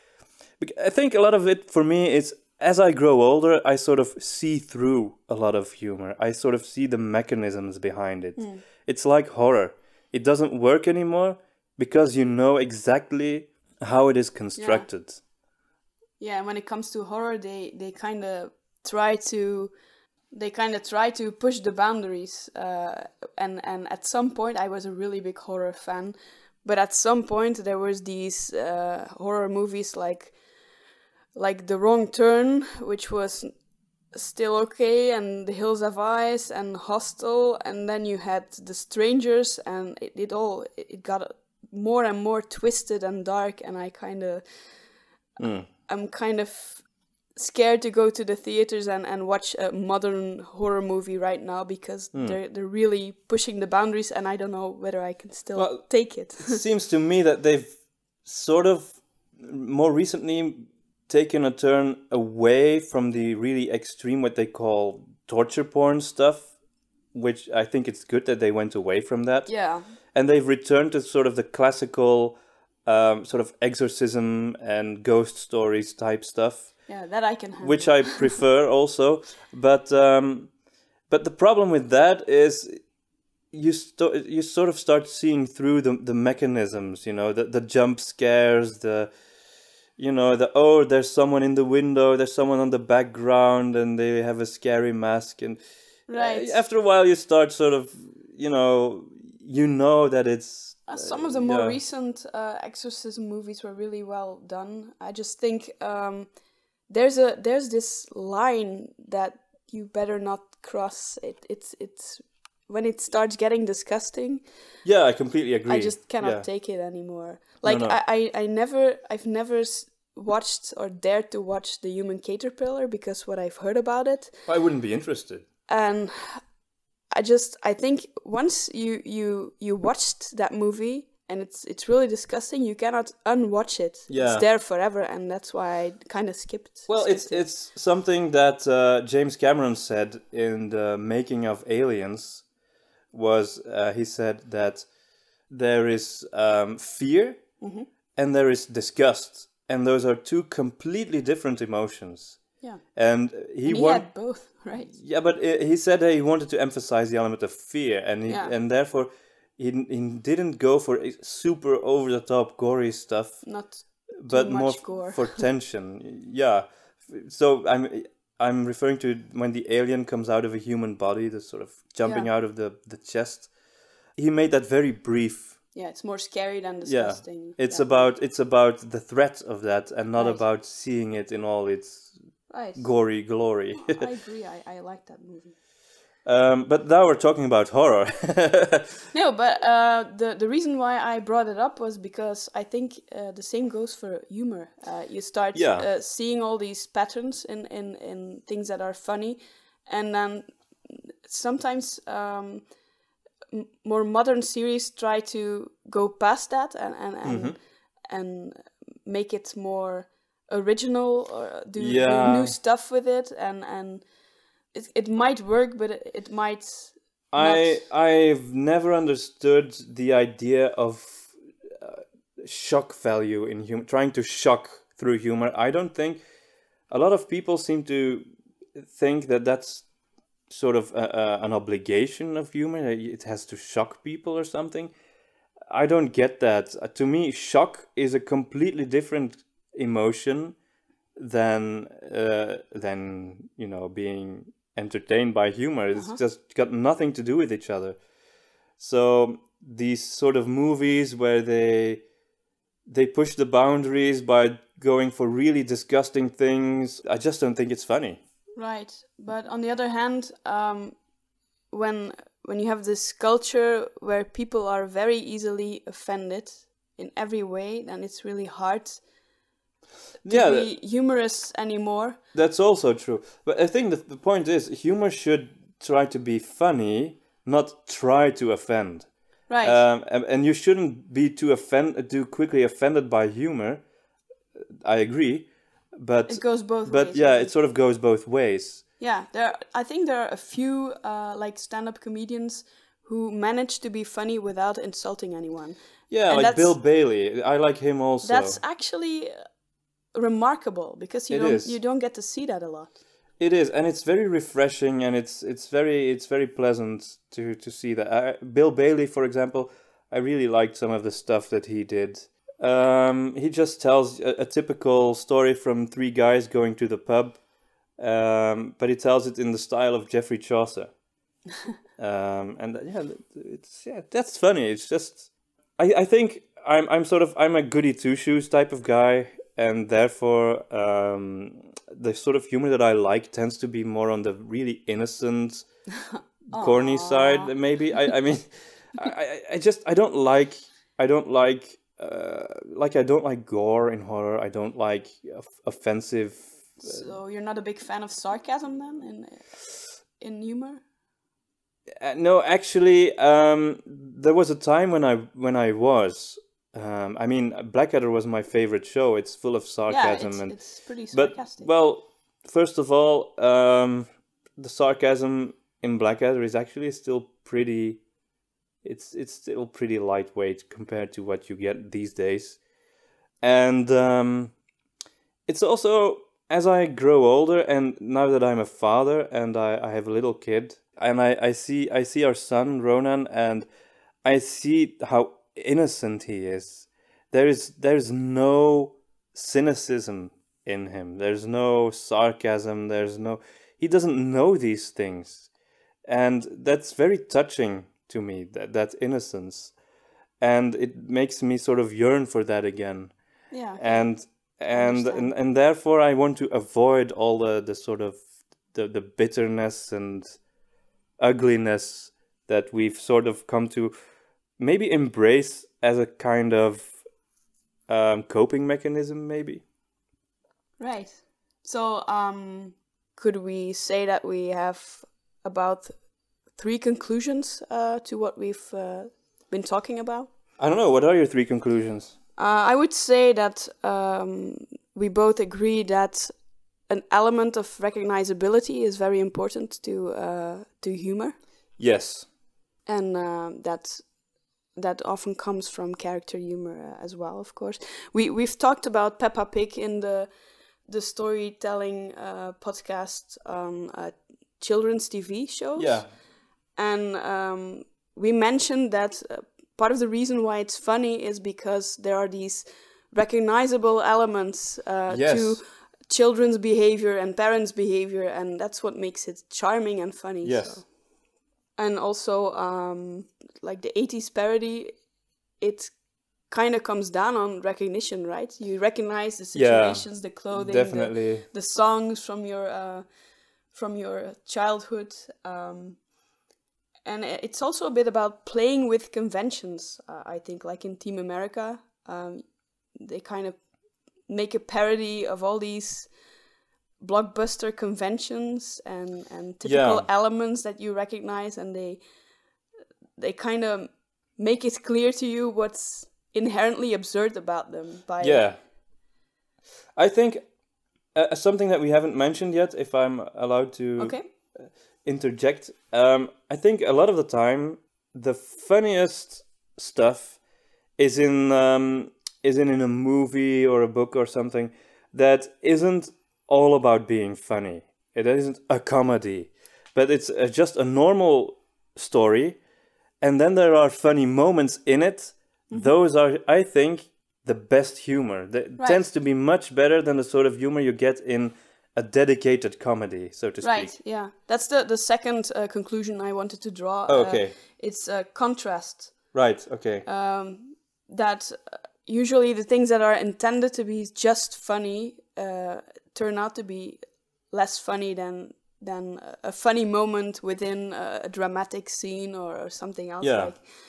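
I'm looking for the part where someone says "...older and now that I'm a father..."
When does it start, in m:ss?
6:17.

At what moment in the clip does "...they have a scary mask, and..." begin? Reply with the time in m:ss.
1:33.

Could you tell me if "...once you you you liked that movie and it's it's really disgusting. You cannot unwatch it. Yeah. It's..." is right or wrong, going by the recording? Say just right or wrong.
wrong.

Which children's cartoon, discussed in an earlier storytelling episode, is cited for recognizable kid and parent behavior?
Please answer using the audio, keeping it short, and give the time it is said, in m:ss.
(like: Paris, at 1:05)
Peppa Pig, at 7:29.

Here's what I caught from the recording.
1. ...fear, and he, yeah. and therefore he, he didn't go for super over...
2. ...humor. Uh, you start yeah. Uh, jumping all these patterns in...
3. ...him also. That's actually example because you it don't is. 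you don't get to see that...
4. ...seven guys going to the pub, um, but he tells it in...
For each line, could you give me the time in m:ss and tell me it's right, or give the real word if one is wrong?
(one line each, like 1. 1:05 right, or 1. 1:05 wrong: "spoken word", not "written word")
1. 2:37 right
2. 3:14 wrong: "seeing", not "jumping"
3. 4:57 wrong: "remarkable", not "example"
4. 5:15 wrong: "three", not "seven".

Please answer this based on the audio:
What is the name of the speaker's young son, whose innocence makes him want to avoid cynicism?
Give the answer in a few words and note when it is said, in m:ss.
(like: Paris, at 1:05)
Ronan, at 6:22.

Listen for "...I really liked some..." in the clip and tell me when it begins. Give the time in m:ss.
5:10.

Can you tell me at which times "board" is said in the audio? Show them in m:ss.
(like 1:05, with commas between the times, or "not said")
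not said.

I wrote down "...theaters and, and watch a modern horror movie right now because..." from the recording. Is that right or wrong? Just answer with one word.
right.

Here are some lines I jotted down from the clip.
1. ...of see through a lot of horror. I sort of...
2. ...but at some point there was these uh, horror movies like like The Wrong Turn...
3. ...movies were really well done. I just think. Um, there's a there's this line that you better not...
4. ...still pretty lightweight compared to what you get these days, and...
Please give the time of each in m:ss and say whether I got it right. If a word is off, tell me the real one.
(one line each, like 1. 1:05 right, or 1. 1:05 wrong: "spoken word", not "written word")
1. 0:03 wrong: "humor", not "horror"
2. 0:26 right
3. 1:43 right
4. 6:09 right.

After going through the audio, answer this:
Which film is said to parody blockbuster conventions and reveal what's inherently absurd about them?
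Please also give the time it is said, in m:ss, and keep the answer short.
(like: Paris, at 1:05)
Team America, at 8:10.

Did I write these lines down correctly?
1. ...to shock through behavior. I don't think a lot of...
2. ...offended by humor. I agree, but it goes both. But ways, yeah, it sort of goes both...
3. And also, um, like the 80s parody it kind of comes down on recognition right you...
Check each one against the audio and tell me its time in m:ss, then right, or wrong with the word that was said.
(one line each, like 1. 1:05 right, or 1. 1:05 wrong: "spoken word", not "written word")
1. 3:44 wrong: "humor", not "behavior"
2. 4:42 right
3. 7:51 right.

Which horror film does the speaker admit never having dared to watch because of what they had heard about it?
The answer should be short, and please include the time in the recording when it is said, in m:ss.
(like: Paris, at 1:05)
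The Human Caterpillar, at 2:01.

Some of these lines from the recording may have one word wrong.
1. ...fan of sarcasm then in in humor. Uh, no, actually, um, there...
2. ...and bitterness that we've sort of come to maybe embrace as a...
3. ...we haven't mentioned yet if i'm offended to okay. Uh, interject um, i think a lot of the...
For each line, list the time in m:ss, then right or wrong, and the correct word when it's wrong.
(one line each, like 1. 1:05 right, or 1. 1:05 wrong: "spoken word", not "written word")
1. 5:47 right
2. 6:49 wrong: "ugliness", not "bitterness"
3. 8:31 wrong: "allowed", not "offended".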